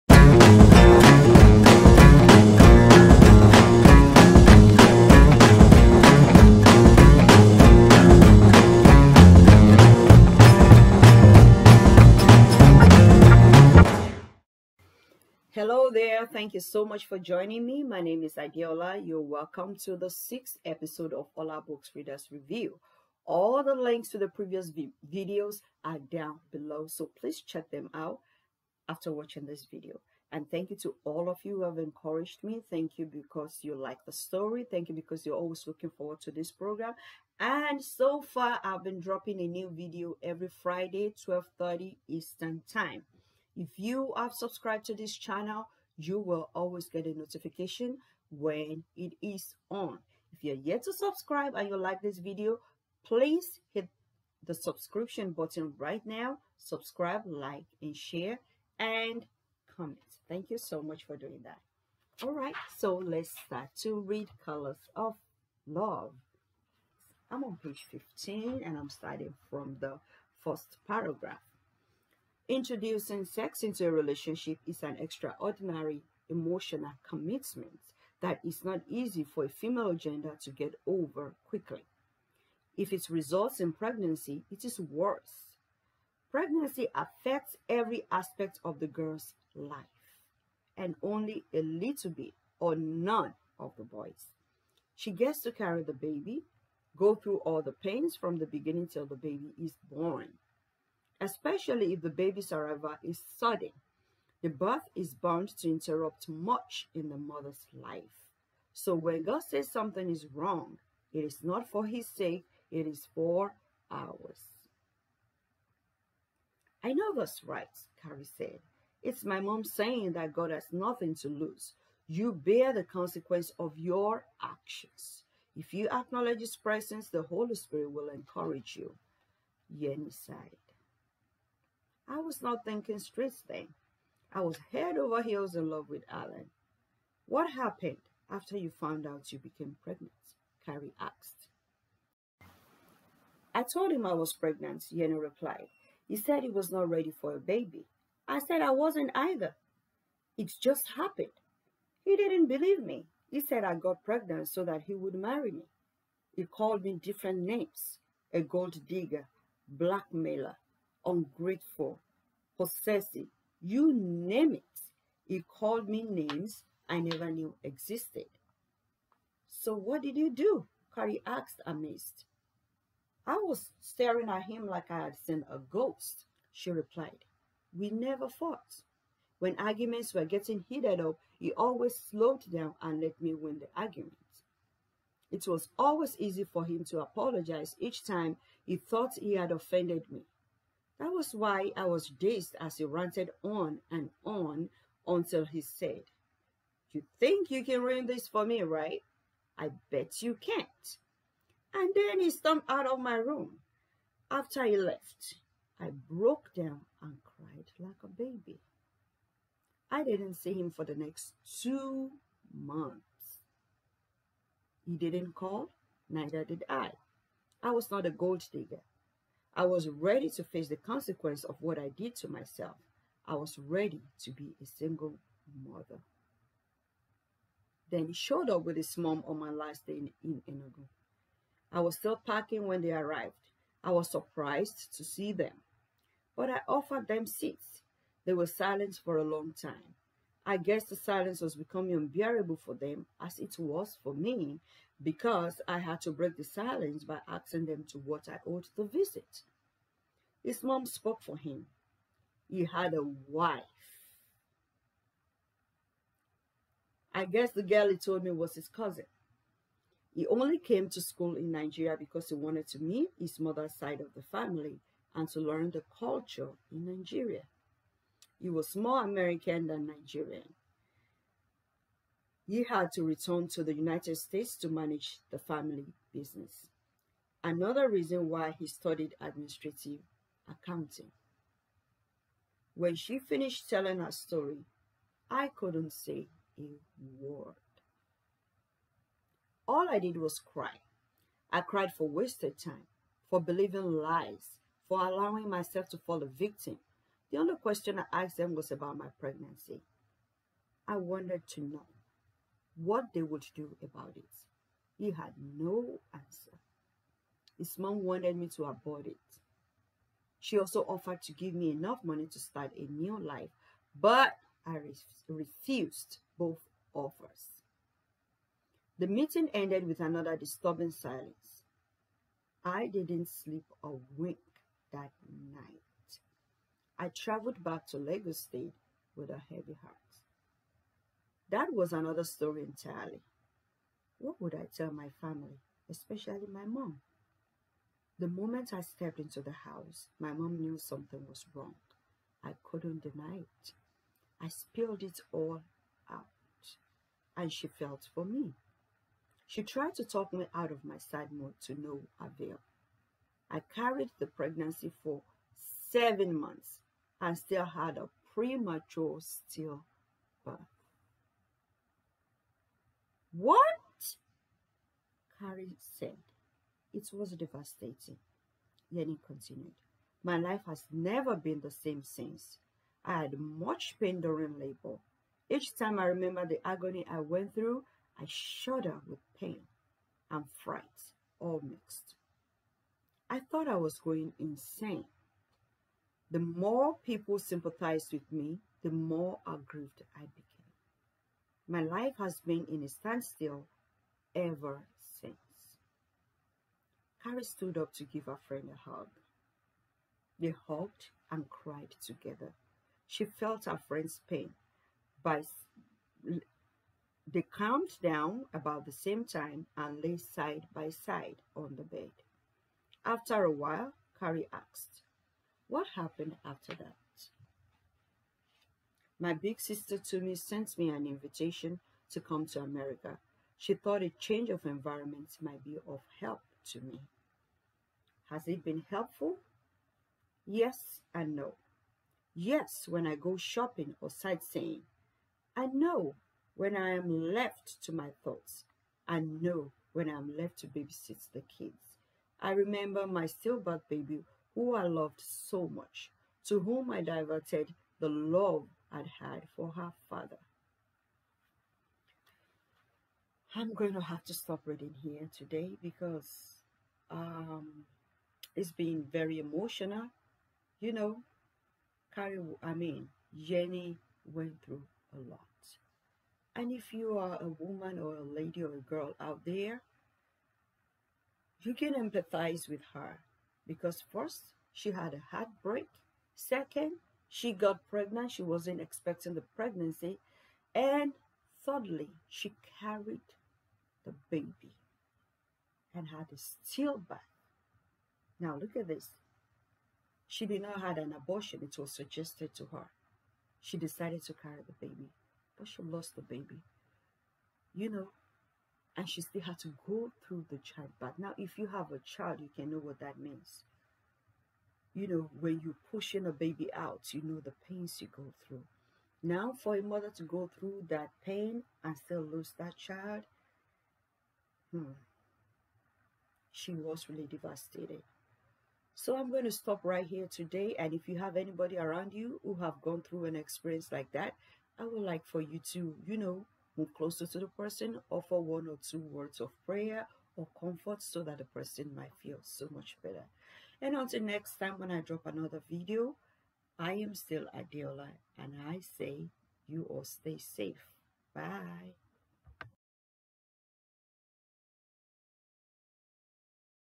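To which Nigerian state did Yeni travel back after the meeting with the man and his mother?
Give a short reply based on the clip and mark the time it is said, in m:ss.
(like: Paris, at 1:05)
Lagos State, at 5:27.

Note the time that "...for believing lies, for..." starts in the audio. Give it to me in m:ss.
4:53.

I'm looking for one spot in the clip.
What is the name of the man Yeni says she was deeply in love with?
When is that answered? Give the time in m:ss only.
2:16.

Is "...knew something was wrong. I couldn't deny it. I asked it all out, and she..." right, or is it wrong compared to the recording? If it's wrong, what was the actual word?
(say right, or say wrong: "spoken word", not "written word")
wrong: "spilled", not "asked".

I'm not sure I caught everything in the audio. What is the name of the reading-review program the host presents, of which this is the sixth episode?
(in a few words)
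Olabooks Readers Review.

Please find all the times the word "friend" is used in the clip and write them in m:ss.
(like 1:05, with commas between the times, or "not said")
6:38, 6:43.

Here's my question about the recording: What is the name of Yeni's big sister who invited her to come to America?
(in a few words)
Tumi.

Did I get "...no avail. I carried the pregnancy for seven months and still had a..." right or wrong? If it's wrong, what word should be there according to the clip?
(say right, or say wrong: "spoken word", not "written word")
right.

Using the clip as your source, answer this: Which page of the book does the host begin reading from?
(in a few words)
15.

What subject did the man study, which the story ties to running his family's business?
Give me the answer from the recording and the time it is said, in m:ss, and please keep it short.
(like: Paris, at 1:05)
administrative accounting, at 4:39.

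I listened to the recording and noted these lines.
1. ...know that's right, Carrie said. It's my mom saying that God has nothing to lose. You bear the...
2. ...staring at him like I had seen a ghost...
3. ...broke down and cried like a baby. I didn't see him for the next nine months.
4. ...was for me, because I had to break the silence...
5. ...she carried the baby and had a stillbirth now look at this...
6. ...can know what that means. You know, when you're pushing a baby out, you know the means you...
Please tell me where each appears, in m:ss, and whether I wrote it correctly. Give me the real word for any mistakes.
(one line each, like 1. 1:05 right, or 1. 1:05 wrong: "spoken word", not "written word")
1. 1:56 right
2. 2:53 right
3. 3:26 wrong: "two", not "nine"
4. 4:03 right
5. 8:02 right
6. 8:22 wrong: "pains", not "means".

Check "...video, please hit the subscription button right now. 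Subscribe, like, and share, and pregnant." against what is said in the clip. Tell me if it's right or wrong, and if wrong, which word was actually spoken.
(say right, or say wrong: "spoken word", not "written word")
wrong: "comment", not "pregnant".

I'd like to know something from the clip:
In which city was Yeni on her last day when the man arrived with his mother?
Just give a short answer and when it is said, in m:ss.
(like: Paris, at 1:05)
Enugu, at 3:50.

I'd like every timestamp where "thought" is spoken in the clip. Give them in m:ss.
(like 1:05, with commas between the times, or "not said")
3:08, 6:23, 7:03, 7:18.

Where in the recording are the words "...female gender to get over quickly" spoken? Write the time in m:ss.
1:19.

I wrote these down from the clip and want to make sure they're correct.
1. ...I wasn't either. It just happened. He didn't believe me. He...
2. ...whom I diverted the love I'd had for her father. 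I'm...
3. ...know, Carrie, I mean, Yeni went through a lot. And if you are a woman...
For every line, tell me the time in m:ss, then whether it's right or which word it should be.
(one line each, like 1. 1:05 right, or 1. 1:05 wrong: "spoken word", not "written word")
1. 2:28 right
2. 7:26 right
3. 7:40 right.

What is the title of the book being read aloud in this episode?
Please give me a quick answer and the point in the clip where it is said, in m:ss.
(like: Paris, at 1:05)
Colors of Love, at 1:04.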